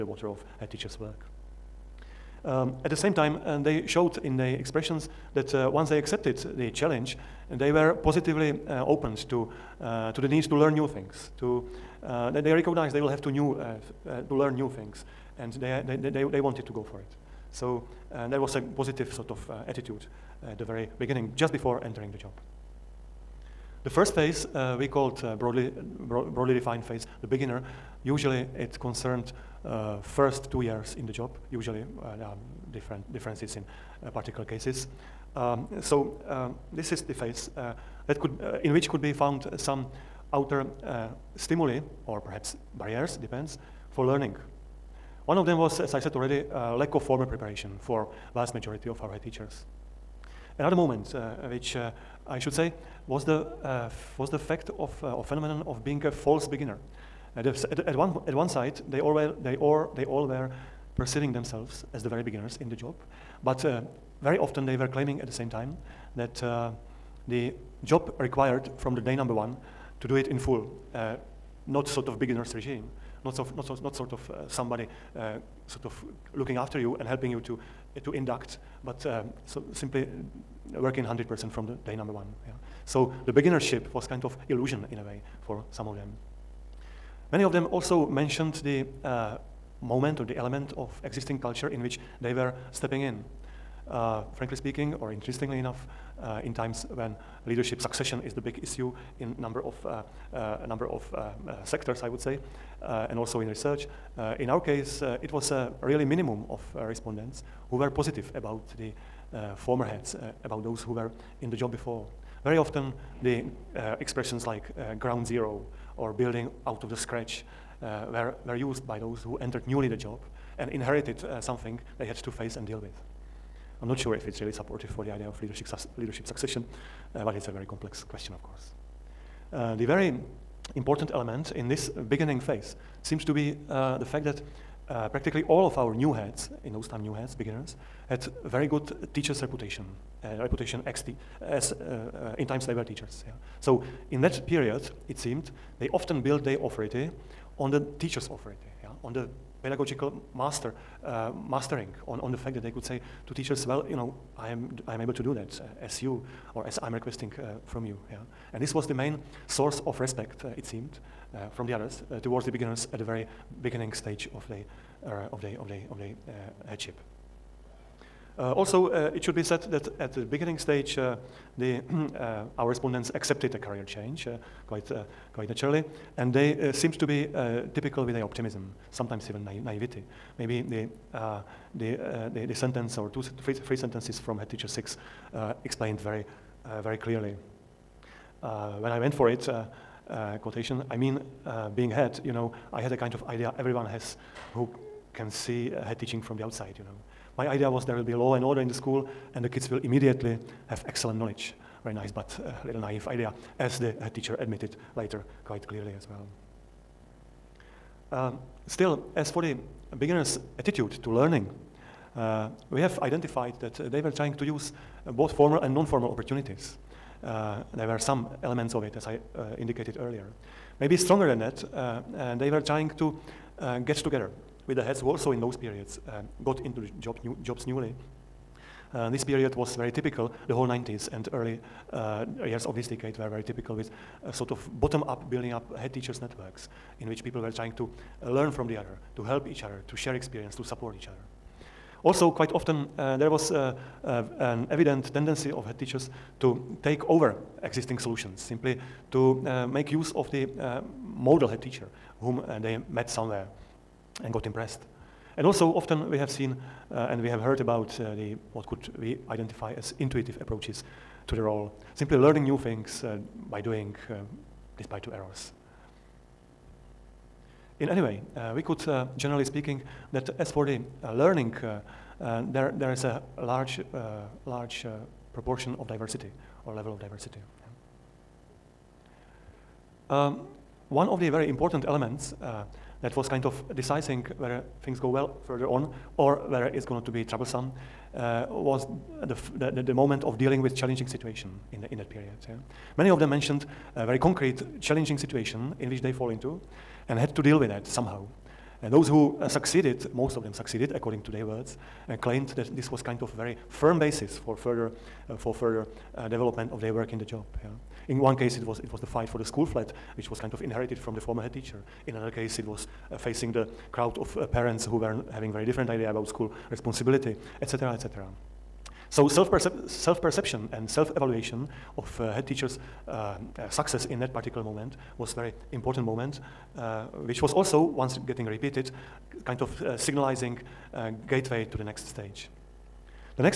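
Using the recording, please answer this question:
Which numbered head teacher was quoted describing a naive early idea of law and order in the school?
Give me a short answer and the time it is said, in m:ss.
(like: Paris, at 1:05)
head teacher 6, at 3:04.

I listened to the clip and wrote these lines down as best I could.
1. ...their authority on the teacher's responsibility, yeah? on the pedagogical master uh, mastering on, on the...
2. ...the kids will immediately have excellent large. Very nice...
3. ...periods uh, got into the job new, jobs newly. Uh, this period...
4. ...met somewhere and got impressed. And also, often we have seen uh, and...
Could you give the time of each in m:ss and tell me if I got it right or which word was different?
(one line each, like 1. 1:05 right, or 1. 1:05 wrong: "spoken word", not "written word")
1. 2:26 wrong: "authority", not "responsibility"
2. 3:19 wrong: "knowledge", not "large"
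3. 3:45 right
4. 4:12 right.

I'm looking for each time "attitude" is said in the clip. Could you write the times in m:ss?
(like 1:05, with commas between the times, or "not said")
0:19, 3:30.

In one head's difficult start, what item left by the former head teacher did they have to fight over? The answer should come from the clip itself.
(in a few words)
the school flat.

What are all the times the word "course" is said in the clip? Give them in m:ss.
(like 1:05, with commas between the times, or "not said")
2:08.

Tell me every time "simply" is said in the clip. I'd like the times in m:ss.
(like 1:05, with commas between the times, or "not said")
1:19, 4:08, 4:21.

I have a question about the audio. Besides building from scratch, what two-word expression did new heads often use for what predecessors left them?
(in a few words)
ground zero.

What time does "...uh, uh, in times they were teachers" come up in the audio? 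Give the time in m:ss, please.
2:21.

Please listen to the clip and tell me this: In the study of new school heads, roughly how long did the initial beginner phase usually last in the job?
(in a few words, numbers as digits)
2 years.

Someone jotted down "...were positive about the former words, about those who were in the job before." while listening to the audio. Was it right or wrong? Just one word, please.
wrong.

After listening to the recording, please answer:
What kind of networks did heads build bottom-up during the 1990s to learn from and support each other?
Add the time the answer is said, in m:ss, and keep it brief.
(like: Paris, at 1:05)
head teachers networks, at 3:55.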